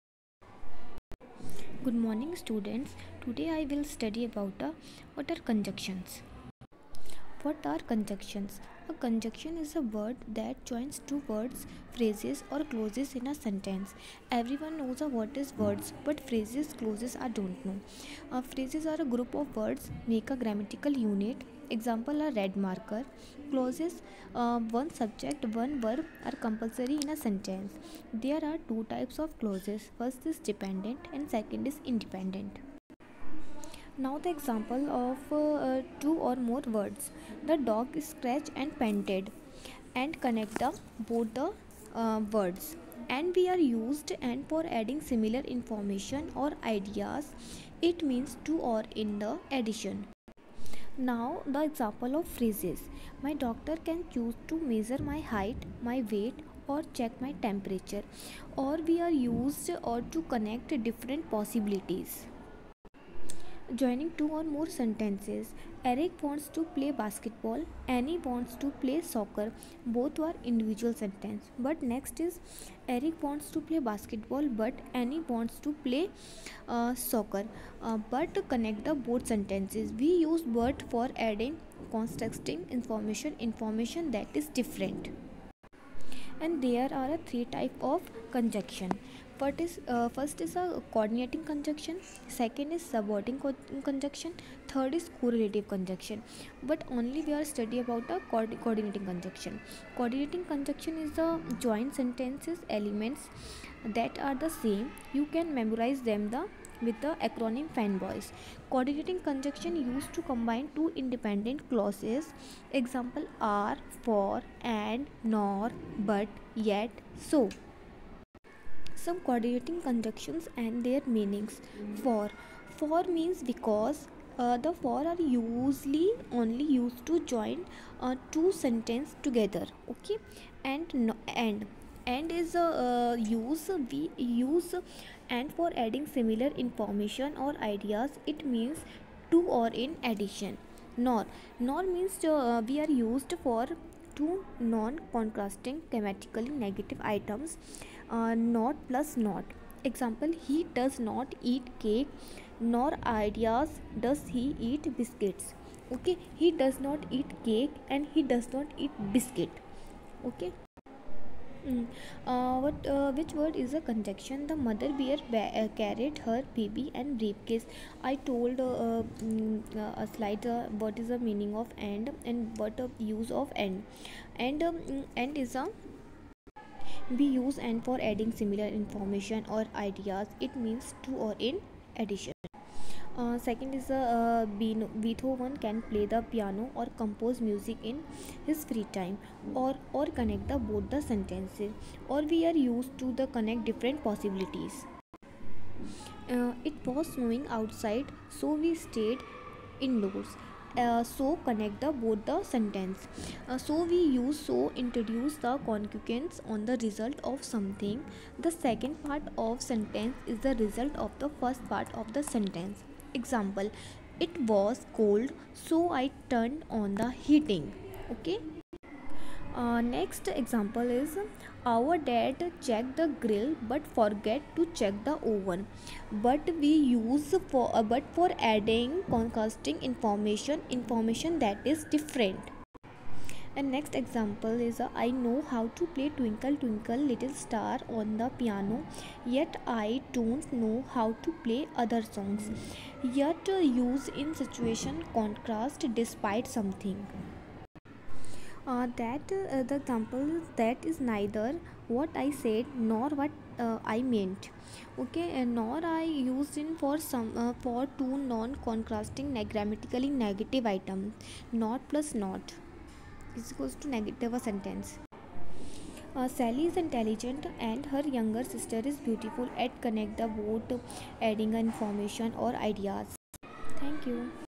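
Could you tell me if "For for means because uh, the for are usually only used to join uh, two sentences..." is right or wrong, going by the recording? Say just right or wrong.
right.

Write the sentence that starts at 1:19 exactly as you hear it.
We use but for adding constructing information, information that is different.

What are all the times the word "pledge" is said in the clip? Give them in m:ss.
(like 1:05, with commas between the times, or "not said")
not said.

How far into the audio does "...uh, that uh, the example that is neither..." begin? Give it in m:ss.
4:08.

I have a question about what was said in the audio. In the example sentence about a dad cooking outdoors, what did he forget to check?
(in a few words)
the oven.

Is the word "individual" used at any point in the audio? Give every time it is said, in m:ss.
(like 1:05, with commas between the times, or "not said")
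1:10.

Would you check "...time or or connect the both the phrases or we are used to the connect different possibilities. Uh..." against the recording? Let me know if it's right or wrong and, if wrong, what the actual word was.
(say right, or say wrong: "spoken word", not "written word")
wrong: "sentences", not "phrases".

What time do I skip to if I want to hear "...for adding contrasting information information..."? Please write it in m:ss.
3:48.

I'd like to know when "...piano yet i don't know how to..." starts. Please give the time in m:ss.
3:58.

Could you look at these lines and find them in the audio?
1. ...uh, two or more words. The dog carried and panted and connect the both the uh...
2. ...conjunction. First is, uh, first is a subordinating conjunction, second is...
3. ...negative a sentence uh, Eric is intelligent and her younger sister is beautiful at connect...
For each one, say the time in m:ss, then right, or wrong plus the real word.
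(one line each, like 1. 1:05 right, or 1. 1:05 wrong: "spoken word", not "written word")
1. 0:35 wrong: "scratched", not "carried"
2. 1:28 wrong: "coordinating", not "subordinating"
3. 4:23 wrong: "Sally", not "Eric".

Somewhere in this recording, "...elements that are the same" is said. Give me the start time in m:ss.
1:42.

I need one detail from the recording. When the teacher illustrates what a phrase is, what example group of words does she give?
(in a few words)
a red marker.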